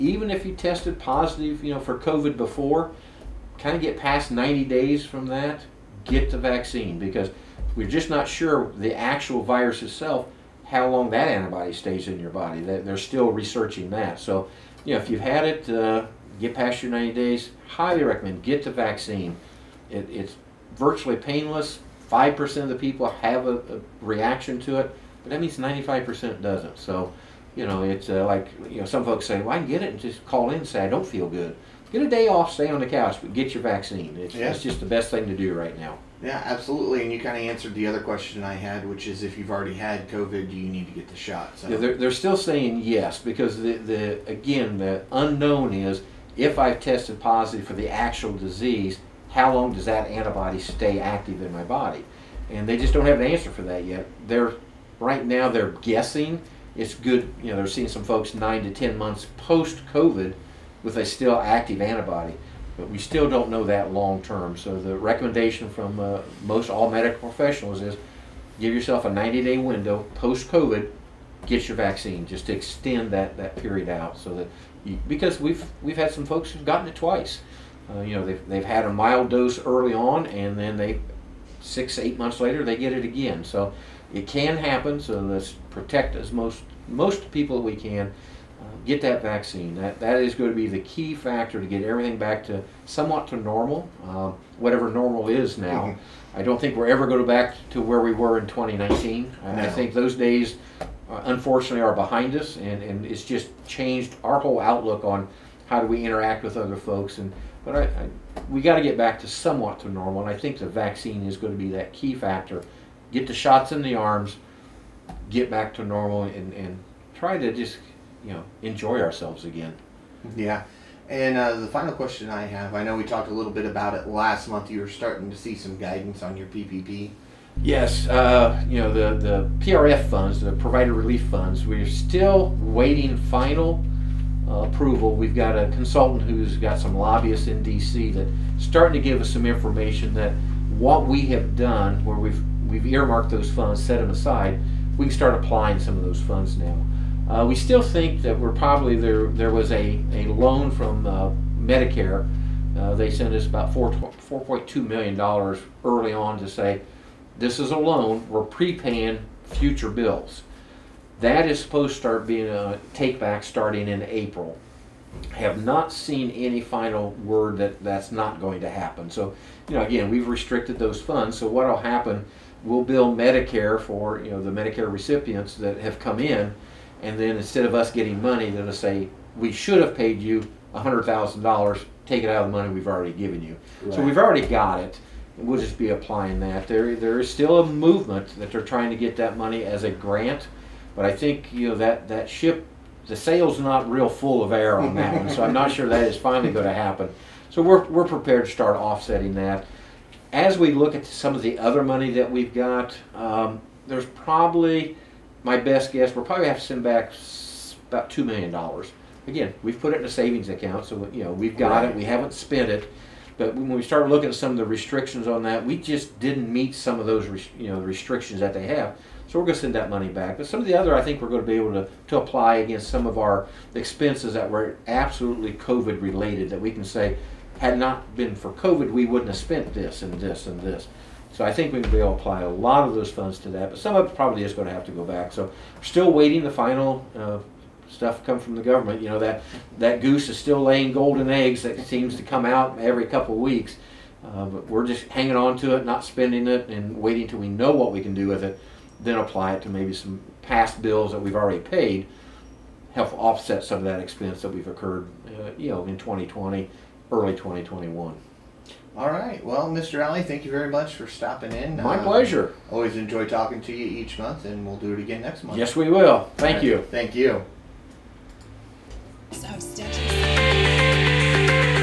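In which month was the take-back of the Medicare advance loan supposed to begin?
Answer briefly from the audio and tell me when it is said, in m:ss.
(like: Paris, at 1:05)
April, at 2:44.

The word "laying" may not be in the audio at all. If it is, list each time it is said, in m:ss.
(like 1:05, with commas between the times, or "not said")
4:00.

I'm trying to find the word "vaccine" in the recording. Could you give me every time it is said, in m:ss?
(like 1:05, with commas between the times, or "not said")
0:06, 0:18, 0:33, 1:11, 1:29, 1:50.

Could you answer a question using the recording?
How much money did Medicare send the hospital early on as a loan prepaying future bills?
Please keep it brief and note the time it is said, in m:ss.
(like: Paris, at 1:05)
$4.2 million, at 2:33.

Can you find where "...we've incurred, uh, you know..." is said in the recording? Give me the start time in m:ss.
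4:14.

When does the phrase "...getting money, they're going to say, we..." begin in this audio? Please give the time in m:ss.
2:57.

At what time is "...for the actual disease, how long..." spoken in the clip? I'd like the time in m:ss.
0:47.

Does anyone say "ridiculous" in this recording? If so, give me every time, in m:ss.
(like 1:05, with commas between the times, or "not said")
not said.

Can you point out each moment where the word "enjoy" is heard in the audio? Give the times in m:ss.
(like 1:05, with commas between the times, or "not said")
1:58, 4:22.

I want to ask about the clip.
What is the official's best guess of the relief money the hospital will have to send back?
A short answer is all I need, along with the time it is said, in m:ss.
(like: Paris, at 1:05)
$2 million, at 3:28.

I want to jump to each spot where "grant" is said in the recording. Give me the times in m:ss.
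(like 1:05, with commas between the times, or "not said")
3:09.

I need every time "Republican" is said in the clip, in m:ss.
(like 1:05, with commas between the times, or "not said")
not said.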